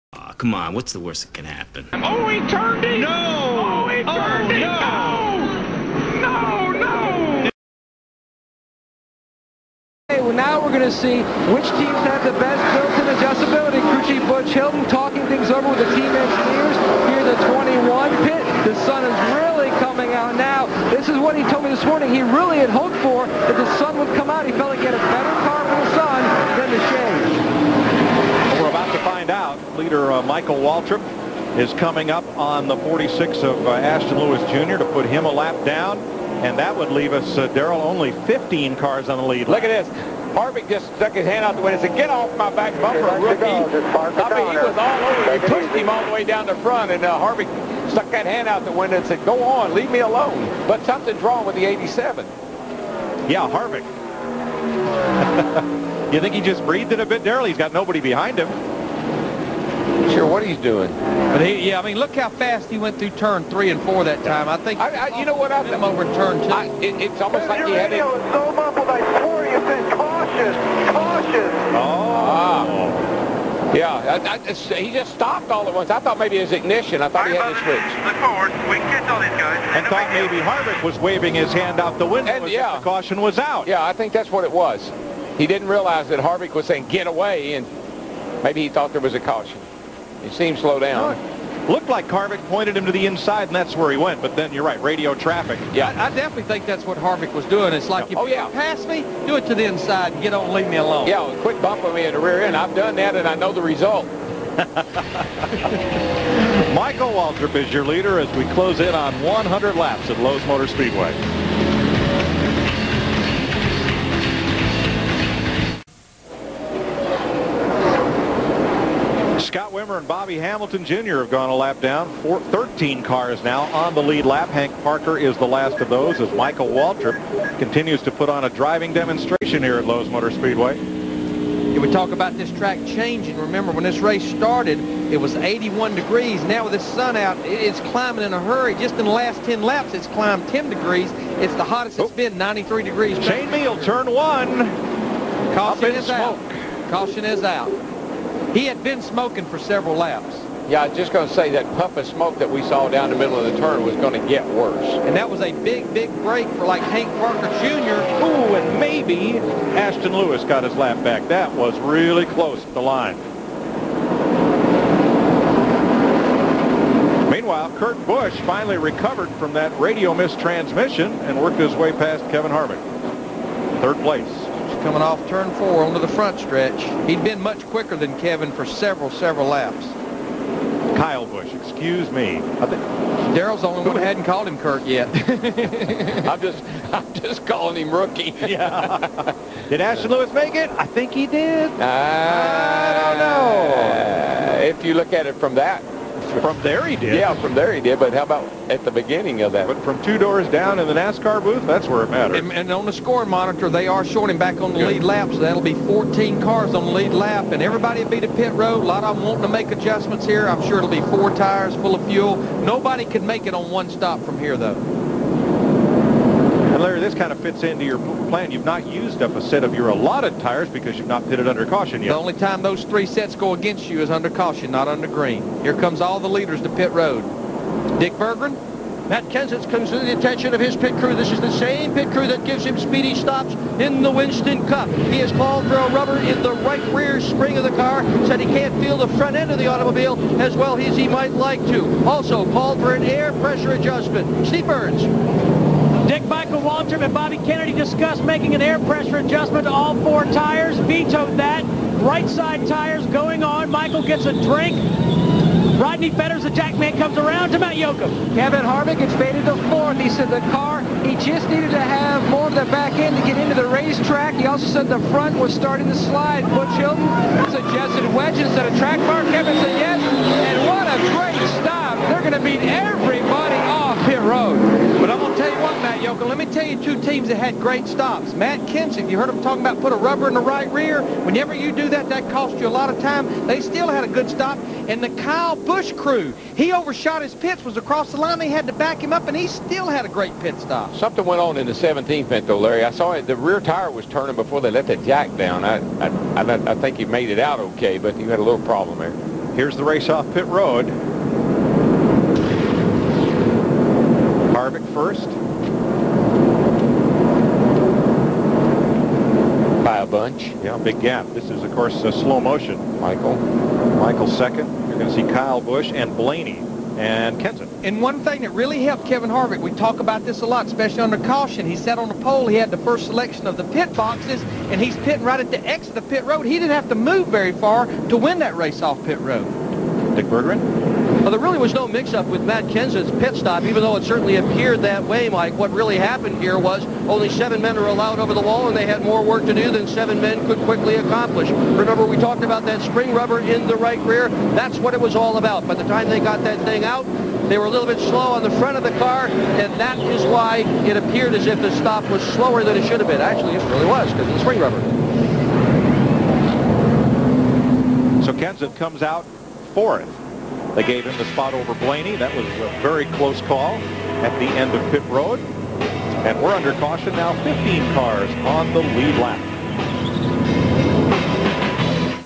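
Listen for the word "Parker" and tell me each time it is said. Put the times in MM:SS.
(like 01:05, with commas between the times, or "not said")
02:04, 02:37.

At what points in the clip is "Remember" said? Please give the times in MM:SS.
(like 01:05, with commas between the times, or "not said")
02:13, 05:41.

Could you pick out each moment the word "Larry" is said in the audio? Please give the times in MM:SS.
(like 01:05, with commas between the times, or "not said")
03:36, 04:52.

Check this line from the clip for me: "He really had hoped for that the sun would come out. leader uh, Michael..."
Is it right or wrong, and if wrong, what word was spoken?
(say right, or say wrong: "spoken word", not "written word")
right.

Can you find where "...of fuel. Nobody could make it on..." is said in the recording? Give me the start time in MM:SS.
03:31.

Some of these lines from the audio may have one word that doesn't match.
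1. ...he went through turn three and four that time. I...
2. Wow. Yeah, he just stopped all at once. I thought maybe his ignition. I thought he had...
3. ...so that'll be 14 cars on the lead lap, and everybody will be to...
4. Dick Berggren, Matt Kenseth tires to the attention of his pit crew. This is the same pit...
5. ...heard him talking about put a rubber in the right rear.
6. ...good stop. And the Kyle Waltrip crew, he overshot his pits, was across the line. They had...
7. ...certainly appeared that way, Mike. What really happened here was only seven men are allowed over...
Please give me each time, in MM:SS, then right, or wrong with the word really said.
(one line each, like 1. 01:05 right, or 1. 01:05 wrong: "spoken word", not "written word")
1. 01:02 right
2. 01:12 right
3. 03:25 right
4. 03:47 wrong: "comes", not "tires"
5. 04:39 right
6. 04:44 wrong: "Busch", not "Waltrip"
7. 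05:34 right.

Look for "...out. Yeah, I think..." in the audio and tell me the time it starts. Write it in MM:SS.
01:23.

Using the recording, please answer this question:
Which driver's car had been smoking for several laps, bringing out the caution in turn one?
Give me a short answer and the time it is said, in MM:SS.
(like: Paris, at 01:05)
Shane Hmiel, at 02:23.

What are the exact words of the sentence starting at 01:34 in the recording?
But then you're right, radio traffic.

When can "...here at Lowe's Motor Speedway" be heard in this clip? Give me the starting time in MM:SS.
02:09.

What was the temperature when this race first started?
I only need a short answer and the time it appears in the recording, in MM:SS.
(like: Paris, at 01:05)
81 degrees, at 02:15.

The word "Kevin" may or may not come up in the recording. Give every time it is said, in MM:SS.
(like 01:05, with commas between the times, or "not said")
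02:52, 02:58, 04:18, 04:29, 05:19.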